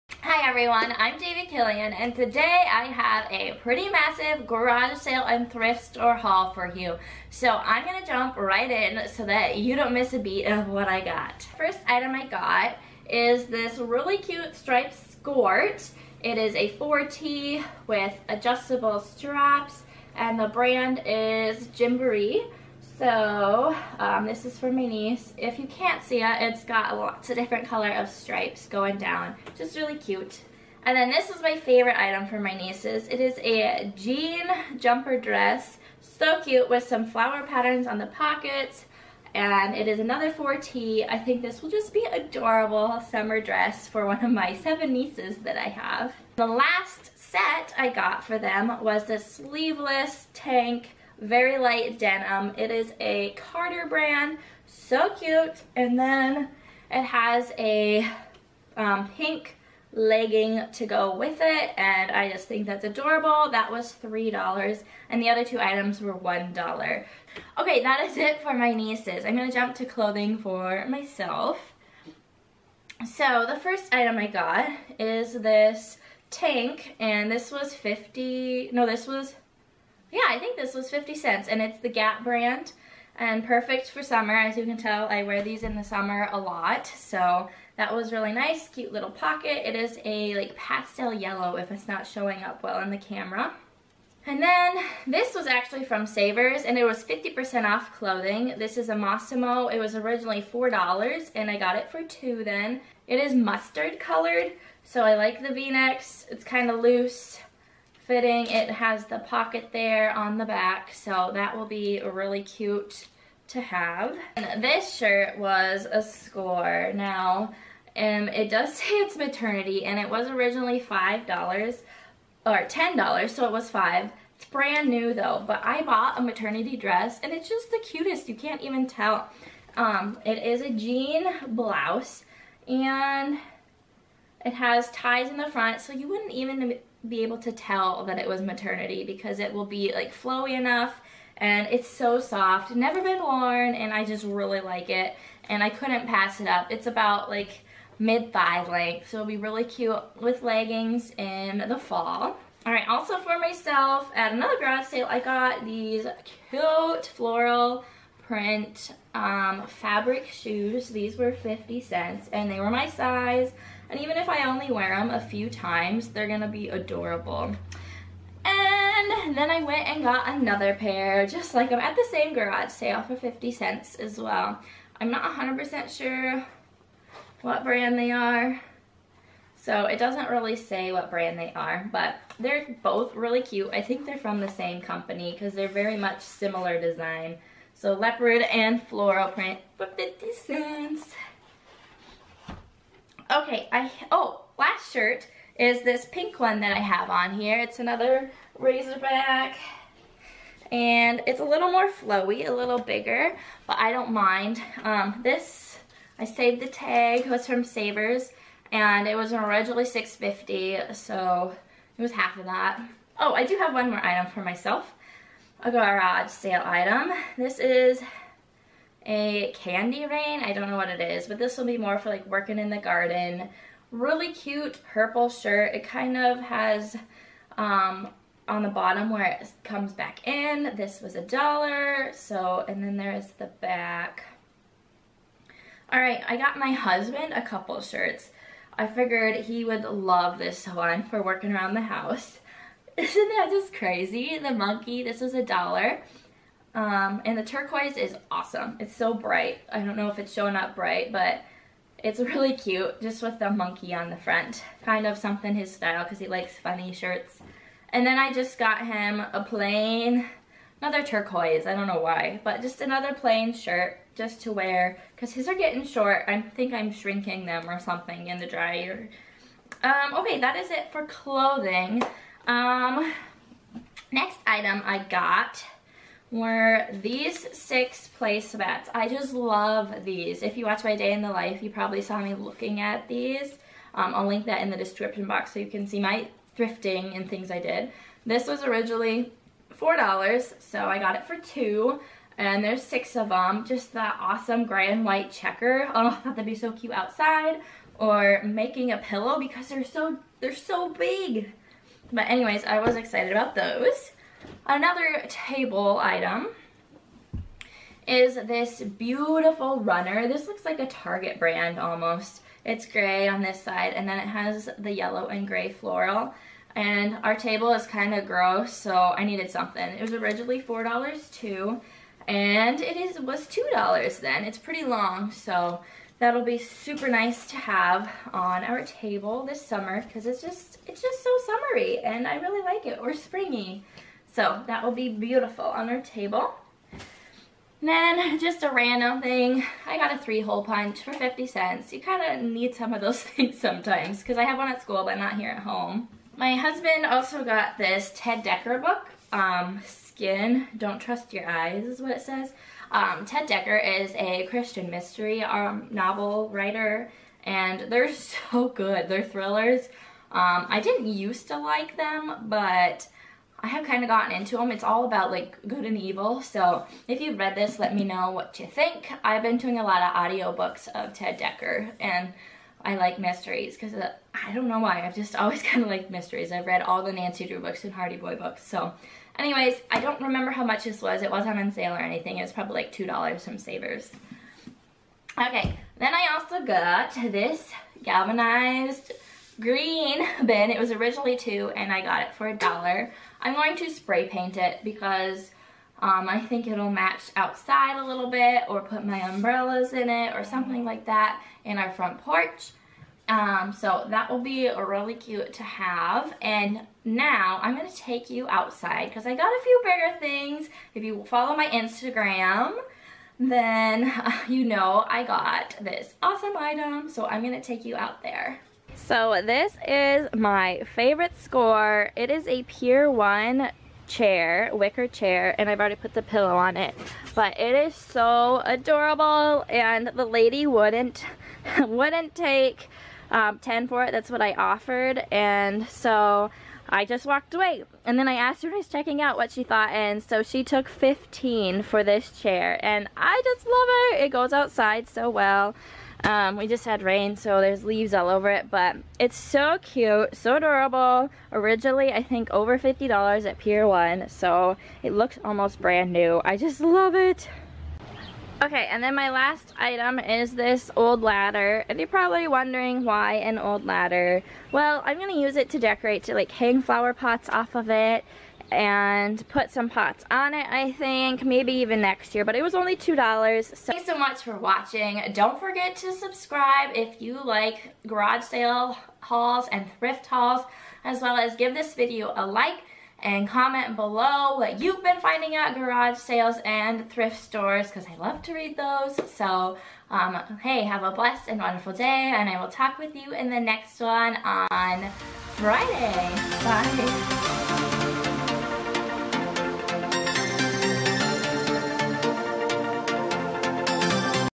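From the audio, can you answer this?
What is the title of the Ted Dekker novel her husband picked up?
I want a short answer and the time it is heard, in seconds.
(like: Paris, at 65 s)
Skin, at 349 s.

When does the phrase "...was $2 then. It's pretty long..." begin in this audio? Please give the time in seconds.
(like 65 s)
323 s.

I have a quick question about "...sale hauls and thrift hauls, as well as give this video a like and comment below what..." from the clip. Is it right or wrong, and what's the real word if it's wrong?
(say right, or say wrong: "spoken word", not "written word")
right.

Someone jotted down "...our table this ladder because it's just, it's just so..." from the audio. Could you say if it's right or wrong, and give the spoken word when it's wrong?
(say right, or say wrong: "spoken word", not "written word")
wrong: "summer", not "ladder".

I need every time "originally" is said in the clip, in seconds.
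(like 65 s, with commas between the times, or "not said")
99 s, 120 s, 209 s, 288 s, 320 s, 390 s, 451 s.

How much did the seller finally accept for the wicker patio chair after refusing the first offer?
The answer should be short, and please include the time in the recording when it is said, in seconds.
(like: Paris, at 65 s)
$15, at 440 s.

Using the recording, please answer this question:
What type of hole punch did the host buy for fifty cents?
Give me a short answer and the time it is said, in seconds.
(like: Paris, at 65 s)
three hole punch, at 340 s.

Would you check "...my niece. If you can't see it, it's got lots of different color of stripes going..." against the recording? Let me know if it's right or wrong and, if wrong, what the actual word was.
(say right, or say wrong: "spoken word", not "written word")
right.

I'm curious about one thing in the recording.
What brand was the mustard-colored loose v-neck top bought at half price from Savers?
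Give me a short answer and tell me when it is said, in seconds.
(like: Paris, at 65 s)
Mossimo, at 98 s.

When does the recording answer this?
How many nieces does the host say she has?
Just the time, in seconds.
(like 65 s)
44 s.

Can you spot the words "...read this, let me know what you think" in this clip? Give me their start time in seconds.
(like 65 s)
367 s.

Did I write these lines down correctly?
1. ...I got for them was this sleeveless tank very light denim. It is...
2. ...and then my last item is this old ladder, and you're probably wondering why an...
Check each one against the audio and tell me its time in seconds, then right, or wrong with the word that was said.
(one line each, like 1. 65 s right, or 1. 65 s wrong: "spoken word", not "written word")
1. 47 s right
2. 458 s right.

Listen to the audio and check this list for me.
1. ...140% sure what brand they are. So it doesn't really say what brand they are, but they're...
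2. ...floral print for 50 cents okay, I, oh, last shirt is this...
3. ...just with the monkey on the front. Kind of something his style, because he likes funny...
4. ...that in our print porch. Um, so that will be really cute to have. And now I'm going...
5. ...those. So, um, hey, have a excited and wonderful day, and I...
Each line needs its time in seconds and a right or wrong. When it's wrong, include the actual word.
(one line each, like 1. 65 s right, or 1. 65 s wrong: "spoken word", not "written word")
1. 175 s wrong: "100", not "140"
2. 188 s right
3. 253 s right
4. 401 s wrong: "front", not "print"
5. 488 s wrong: "blessed", not "excited".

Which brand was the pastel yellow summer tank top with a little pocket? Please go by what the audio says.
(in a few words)
Gap.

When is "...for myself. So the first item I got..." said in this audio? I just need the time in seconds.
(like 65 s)
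70 s.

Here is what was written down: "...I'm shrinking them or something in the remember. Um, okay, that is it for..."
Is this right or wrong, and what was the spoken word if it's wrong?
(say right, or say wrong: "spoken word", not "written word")
wrong: "dryer", not "remember".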